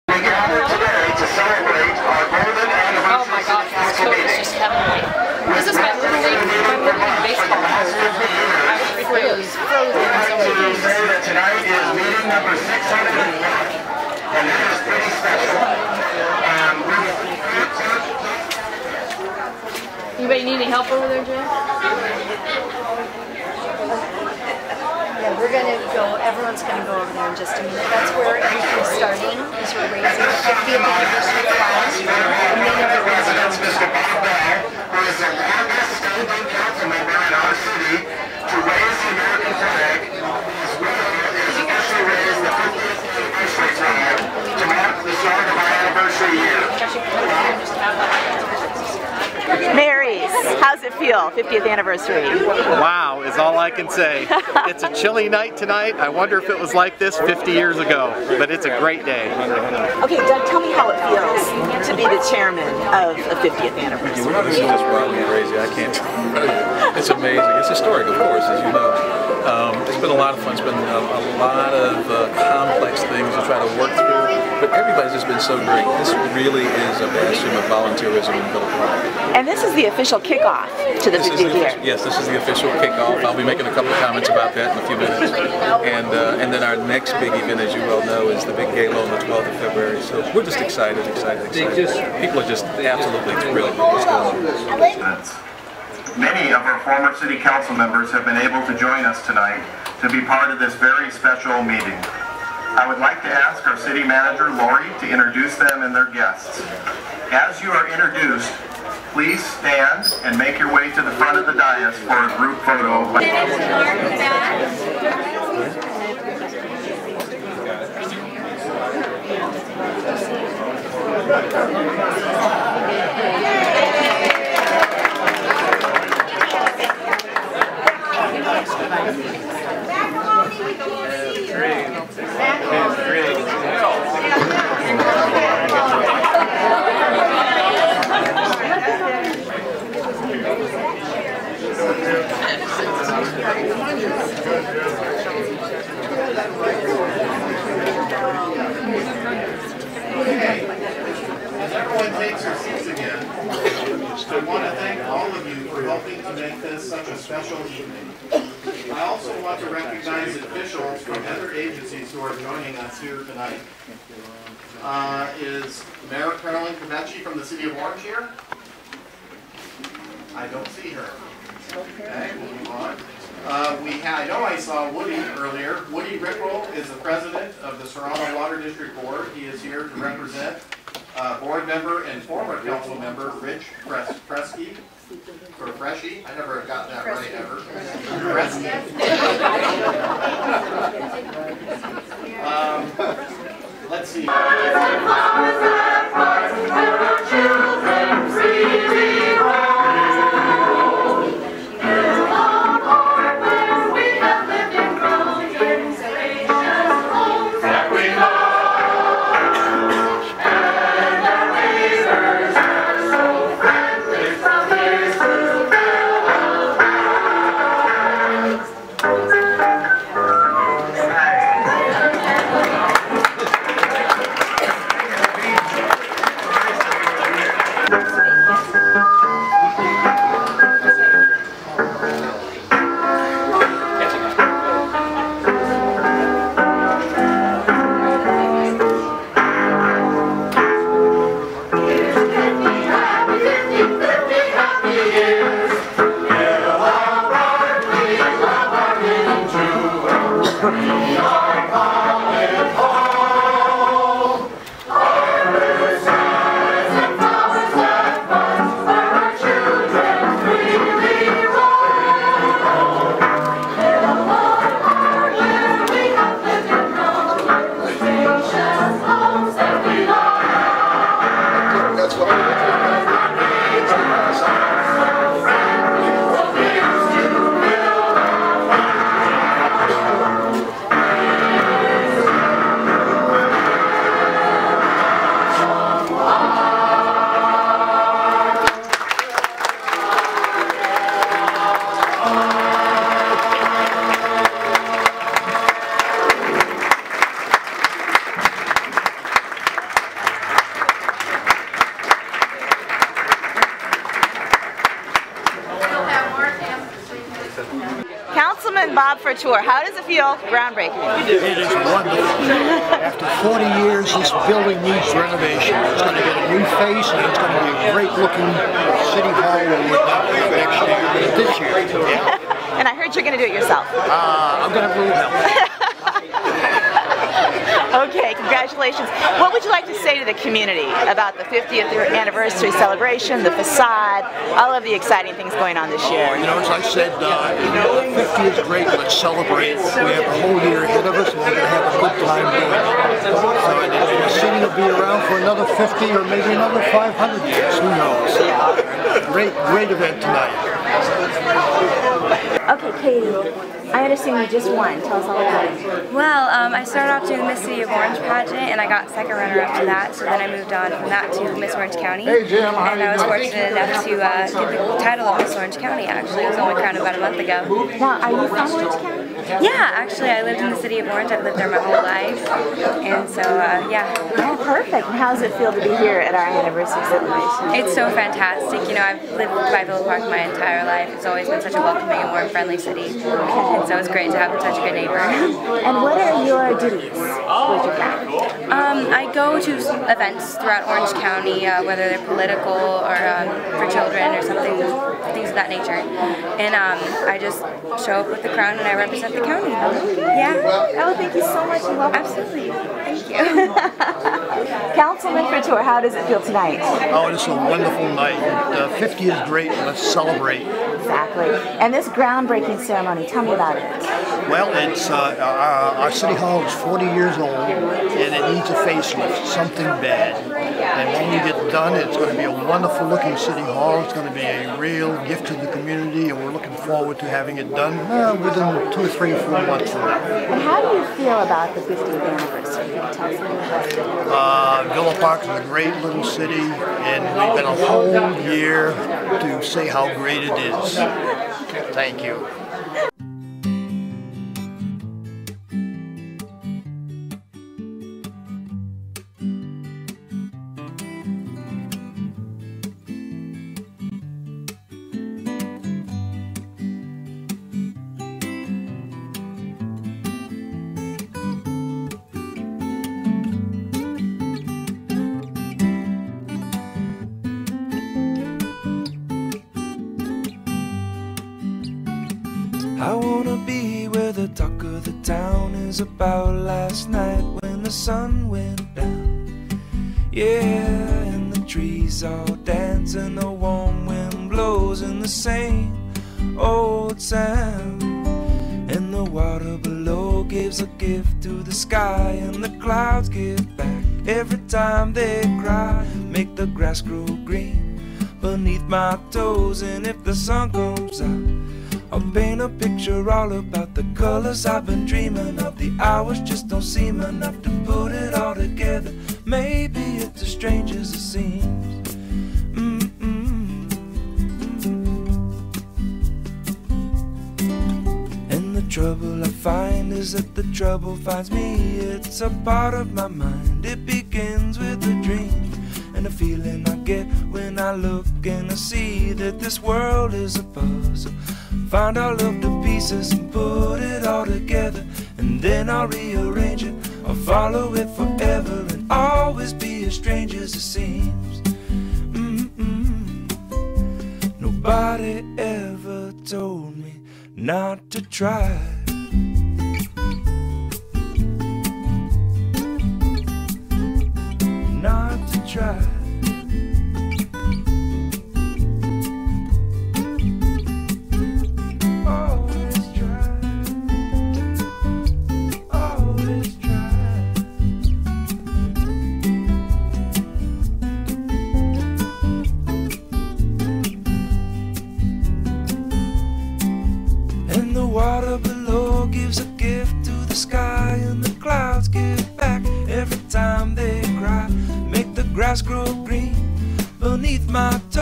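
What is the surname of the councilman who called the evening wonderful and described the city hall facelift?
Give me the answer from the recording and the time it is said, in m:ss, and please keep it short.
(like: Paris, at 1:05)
Couture, at 6:45.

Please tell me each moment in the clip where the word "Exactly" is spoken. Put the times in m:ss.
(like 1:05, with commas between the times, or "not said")
6:50.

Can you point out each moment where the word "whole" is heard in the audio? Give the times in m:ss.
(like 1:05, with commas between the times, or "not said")
5:40, 6:11, 7:17.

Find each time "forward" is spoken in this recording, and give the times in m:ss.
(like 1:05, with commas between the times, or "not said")
7:06.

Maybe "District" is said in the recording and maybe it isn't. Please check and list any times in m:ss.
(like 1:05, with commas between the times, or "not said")
2:58.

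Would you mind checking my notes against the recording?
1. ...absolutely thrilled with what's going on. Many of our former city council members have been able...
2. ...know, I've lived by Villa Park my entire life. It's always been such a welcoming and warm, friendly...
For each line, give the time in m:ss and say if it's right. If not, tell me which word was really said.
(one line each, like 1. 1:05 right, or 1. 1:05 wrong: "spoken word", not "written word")
1. 1:32 right
2. 6:18 right.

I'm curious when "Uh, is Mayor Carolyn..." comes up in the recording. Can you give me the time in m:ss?
2:44.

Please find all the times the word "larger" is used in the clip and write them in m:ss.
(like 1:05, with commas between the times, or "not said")
not said.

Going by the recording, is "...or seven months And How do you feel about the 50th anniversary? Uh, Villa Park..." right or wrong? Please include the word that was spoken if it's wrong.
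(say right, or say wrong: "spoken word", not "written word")
wrong: "four", not "seven".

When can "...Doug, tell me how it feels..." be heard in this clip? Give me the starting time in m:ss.
1:00.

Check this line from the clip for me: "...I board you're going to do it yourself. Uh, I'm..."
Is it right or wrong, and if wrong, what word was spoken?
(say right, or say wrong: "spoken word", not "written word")
wrong: "heard", not "board".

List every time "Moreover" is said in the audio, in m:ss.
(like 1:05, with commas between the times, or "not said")
not said.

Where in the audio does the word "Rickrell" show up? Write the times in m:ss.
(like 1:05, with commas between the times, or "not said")
2:56.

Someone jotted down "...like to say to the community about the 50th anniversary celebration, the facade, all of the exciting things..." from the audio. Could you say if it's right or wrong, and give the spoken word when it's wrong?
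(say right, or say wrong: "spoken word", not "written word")
right.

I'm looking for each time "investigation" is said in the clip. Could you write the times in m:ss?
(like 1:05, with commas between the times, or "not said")
not said.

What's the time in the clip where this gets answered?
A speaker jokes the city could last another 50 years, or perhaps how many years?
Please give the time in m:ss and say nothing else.
5:46.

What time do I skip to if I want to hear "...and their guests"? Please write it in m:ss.
1:45.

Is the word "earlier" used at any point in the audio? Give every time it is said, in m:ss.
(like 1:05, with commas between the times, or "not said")
2:55.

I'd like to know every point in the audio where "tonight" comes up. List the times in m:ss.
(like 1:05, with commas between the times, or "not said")
0:55, 1:39, 2:43, 5:50, 6:46.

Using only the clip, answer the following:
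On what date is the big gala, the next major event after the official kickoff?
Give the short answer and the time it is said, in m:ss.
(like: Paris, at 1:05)
February 12, at 1:29.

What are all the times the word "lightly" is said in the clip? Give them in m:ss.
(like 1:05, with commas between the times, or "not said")
not said.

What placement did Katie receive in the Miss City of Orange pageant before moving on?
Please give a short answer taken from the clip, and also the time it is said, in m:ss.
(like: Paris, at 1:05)
second runner-up, at 5:59.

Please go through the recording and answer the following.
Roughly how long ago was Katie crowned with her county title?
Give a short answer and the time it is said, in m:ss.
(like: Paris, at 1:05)
a month ago, at 6:06.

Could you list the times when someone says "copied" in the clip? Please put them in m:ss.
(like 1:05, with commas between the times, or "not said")
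not said.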